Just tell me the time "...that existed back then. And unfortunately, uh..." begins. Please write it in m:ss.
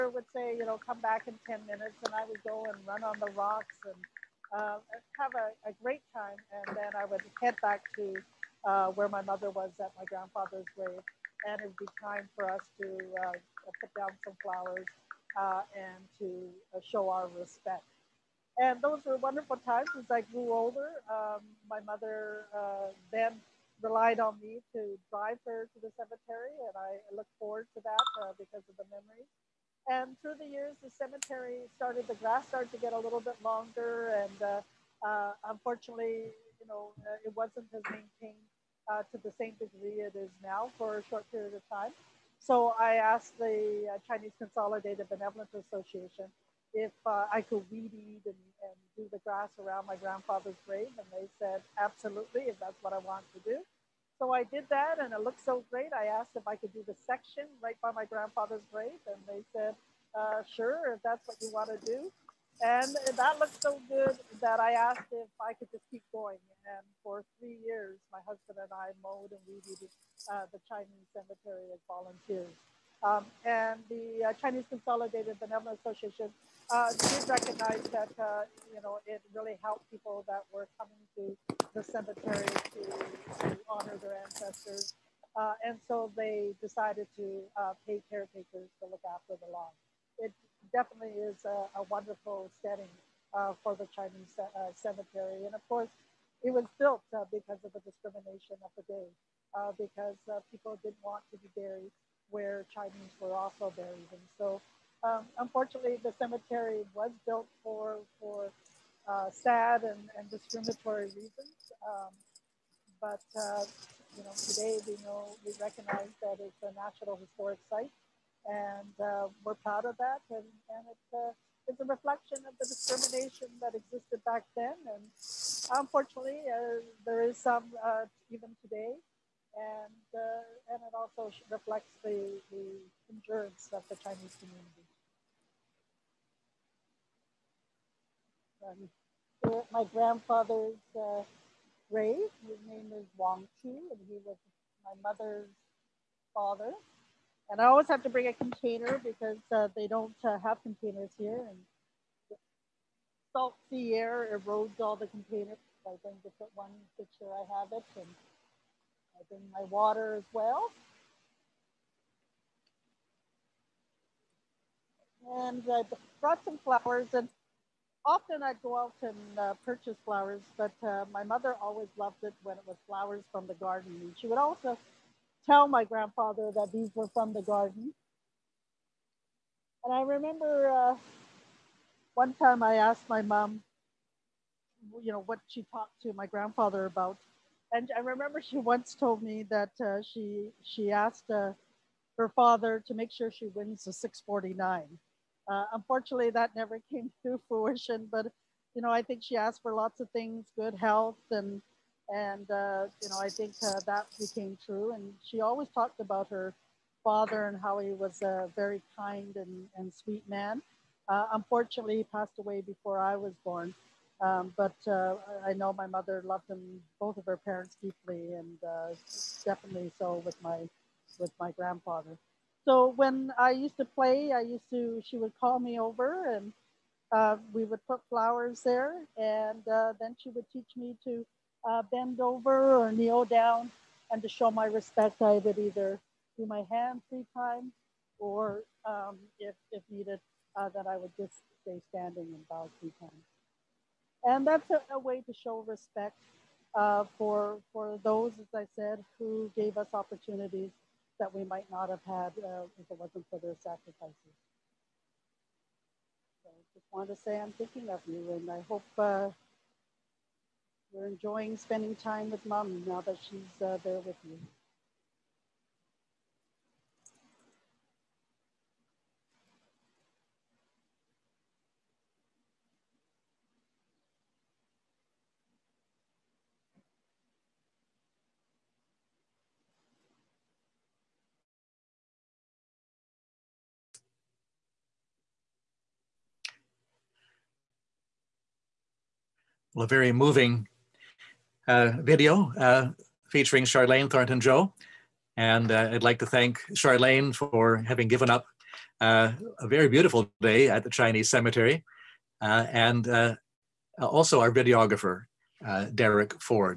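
2:03.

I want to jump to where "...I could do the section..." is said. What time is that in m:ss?
0:56.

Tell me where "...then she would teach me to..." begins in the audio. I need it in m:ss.
3:49.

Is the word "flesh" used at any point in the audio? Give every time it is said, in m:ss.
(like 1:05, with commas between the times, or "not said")
not said.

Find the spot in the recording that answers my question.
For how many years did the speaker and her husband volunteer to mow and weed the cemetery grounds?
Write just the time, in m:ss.
1:07.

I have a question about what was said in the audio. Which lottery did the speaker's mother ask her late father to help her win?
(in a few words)
649.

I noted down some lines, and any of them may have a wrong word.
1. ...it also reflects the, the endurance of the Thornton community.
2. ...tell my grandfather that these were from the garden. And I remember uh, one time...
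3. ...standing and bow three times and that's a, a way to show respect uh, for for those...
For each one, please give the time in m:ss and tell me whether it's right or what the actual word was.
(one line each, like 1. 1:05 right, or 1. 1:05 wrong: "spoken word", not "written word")
1. 2:10 wrong: "Chinese", not "Thornton"
2. 2:55 right
3. 4:01 right.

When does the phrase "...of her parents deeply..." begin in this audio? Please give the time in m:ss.
3:37.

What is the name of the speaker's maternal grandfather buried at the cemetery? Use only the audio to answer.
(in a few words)
Wang Chu.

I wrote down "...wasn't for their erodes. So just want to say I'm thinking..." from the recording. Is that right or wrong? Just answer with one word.
wrong.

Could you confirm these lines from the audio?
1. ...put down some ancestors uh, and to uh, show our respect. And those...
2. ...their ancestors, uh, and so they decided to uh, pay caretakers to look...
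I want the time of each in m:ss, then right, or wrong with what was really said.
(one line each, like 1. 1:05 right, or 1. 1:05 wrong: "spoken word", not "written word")
1. 0:13 wrong: "flowers", not "ancestors"
2. 1:24 right.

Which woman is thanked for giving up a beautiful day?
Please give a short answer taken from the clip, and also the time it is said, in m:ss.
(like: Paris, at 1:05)
Charlayne Thornton Joe, at 4:53.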